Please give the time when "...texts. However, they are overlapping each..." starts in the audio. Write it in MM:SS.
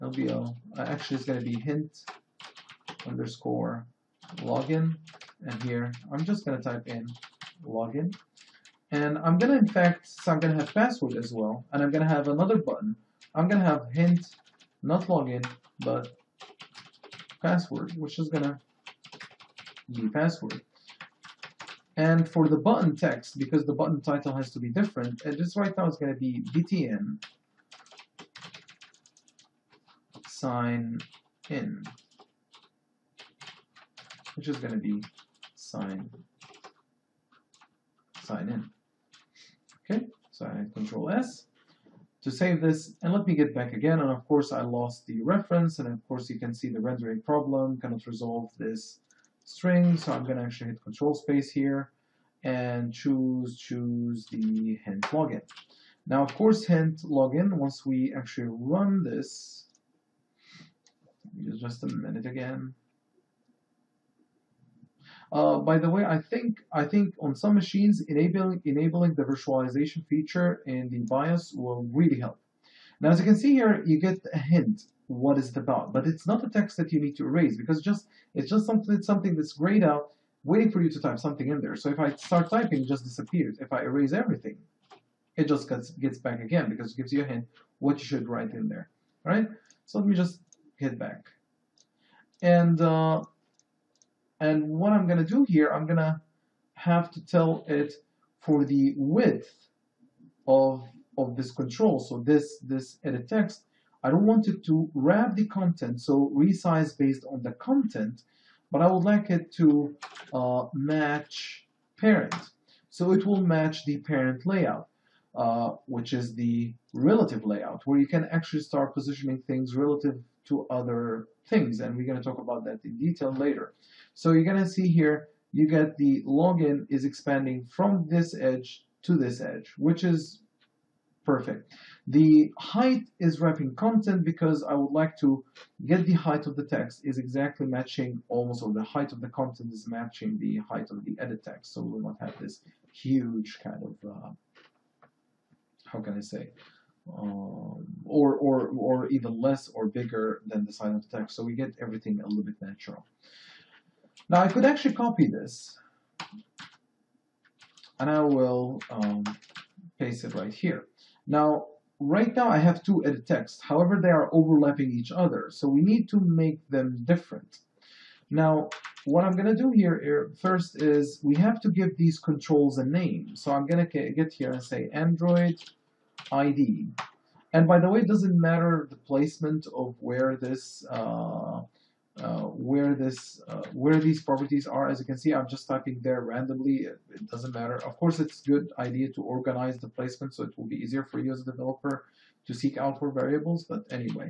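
02:43.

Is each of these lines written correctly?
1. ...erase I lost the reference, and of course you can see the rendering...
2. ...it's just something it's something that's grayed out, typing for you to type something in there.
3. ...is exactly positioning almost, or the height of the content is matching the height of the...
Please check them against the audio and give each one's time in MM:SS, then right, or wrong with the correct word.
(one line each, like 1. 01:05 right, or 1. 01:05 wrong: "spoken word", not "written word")
1. 00:44 wrong: "course", not "erase"
2. 01:18 wrong: "waiting", not "typing"
3. 02:17 wrong: "matching", not "positioning".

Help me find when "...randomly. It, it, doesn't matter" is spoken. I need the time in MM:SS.
03:06.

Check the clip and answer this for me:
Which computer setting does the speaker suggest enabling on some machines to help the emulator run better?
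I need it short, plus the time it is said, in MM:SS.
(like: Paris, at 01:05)
virtualization feature in the BIOS, at 01:09.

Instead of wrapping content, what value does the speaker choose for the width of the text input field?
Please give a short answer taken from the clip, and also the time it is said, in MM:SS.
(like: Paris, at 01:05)
match parent, at 01:50.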